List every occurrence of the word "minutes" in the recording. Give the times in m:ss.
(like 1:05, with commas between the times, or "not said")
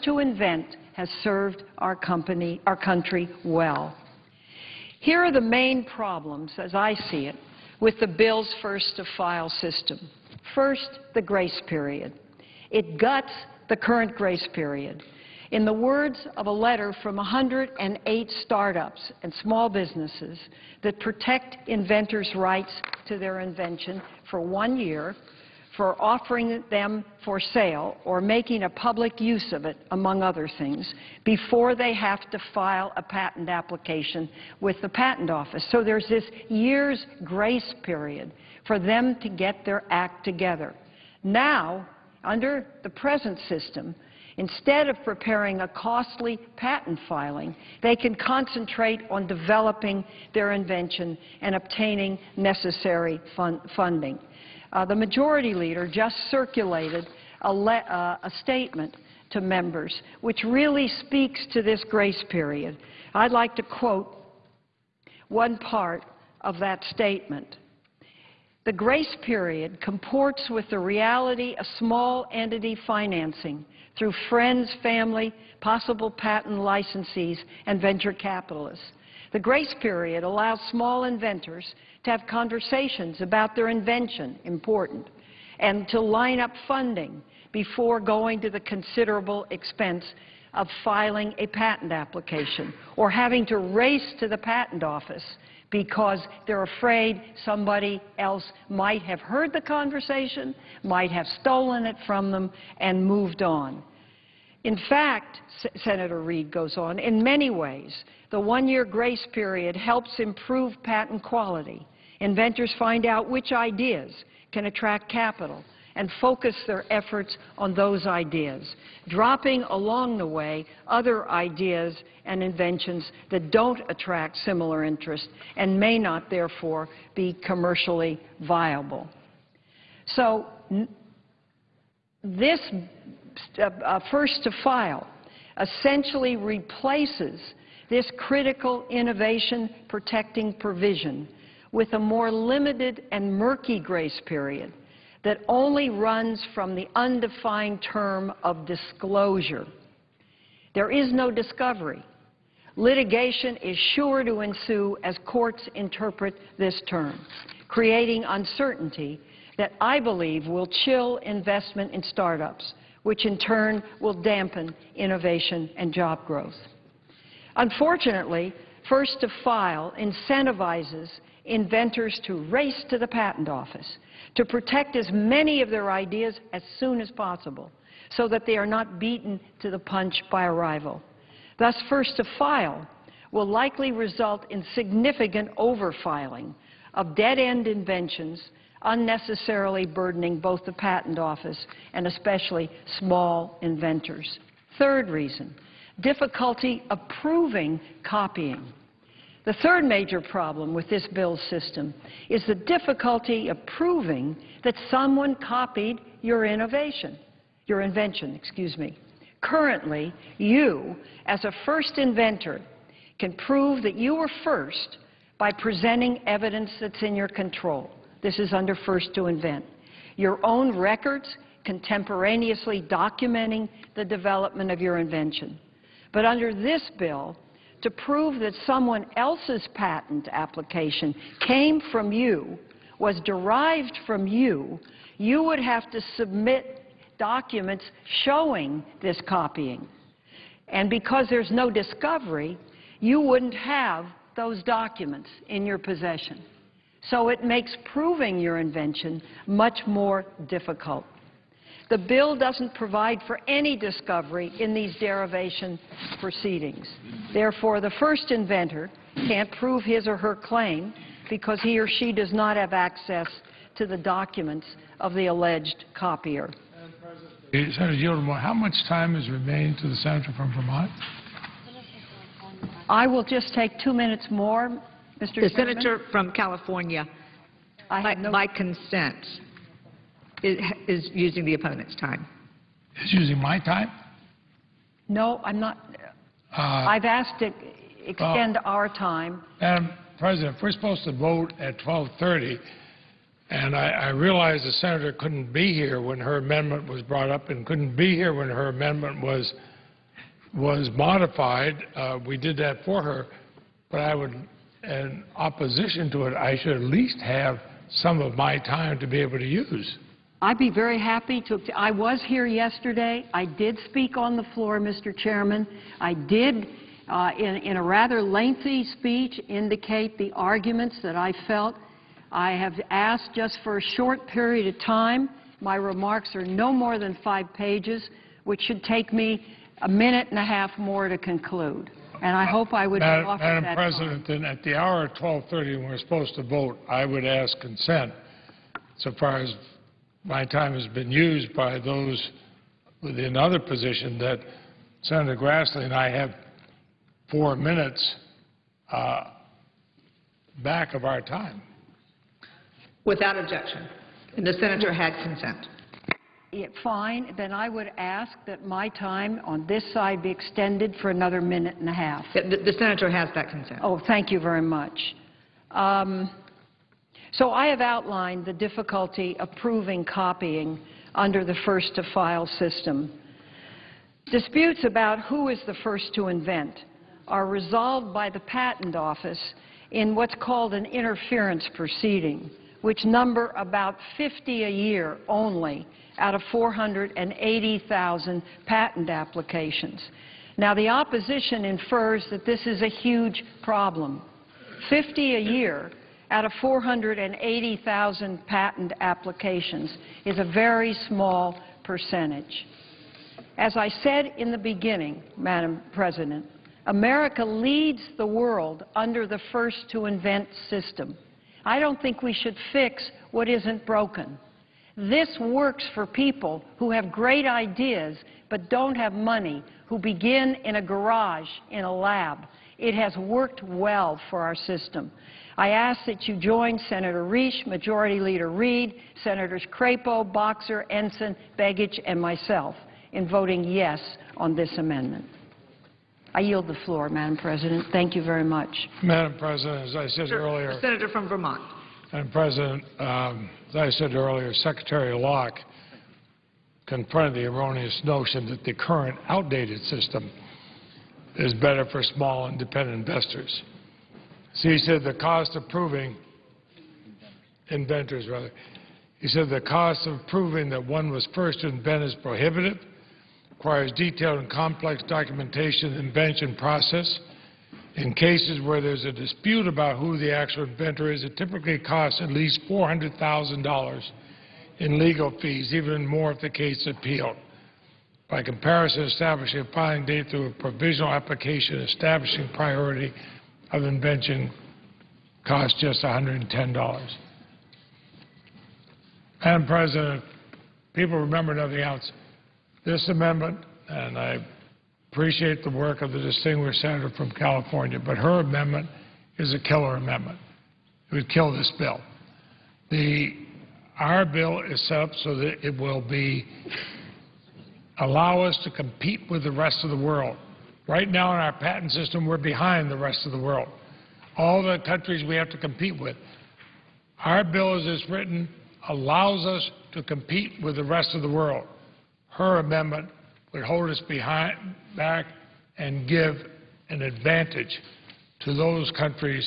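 4:33, 5:29, 5:47, 6:01.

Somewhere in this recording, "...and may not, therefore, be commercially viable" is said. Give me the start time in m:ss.
2:05.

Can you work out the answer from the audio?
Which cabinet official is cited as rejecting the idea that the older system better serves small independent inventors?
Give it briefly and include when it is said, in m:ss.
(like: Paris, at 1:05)
Secretary Locke, at 7:24.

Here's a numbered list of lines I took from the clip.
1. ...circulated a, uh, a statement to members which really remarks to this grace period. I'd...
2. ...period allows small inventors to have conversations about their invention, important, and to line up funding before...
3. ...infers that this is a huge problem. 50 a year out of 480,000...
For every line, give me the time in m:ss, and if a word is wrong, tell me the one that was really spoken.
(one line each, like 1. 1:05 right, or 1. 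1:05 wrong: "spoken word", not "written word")
1. 0:56 wrong: "speaks", not "remarks"
2. 1:19 right
3. 6:31 right.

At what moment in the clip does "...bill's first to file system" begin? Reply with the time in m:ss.
0:08.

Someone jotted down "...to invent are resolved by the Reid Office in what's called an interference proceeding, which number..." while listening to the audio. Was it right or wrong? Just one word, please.
wrong.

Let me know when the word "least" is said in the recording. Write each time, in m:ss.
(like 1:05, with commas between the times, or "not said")
5:06, 7:52.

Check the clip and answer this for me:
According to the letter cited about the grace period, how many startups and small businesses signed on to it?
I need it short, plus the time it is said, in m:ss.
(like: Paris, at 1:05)
108, at 0:17.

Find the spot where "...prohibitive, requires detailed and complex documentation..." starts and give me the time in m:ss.
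7:42.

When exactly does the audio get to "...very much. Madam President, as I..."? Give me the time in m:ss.
7:18.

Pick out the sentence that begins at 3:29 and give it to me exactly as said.
Currently, you, as a first inventor, can prove that you were first by presenting evidence that's in your control.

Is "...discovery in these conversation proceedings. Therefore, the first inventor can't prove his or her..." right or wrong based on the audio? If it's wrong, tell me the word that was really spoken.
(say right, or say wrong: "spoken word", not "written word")
wrong: "derivation", not "conversation".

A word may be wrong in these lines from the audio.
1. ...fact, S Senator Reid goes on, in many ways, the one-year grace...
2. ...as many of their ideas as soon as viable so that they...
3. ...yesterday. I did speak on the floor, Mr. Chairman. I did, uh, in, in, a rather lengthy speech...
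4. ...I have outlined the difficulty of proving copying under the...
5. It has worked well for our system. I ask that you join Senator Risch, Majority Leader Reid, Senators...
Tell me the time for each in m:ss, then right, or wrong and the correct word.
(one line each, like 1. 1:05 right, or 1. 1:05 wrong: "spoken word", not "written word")
1. 1:44 right
2. 2:54 wrong: "possible", not "viable"
3. 5:12 right
4. 6:07 right
5. 7:02 right.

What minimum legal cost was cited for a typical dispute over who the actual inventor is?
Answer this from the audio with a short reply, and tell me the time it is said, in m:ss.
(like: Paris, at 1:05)
$400,000, at 7:52.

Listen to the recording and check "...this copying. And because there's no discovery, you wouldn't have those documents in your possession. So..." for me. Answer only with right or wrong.
right.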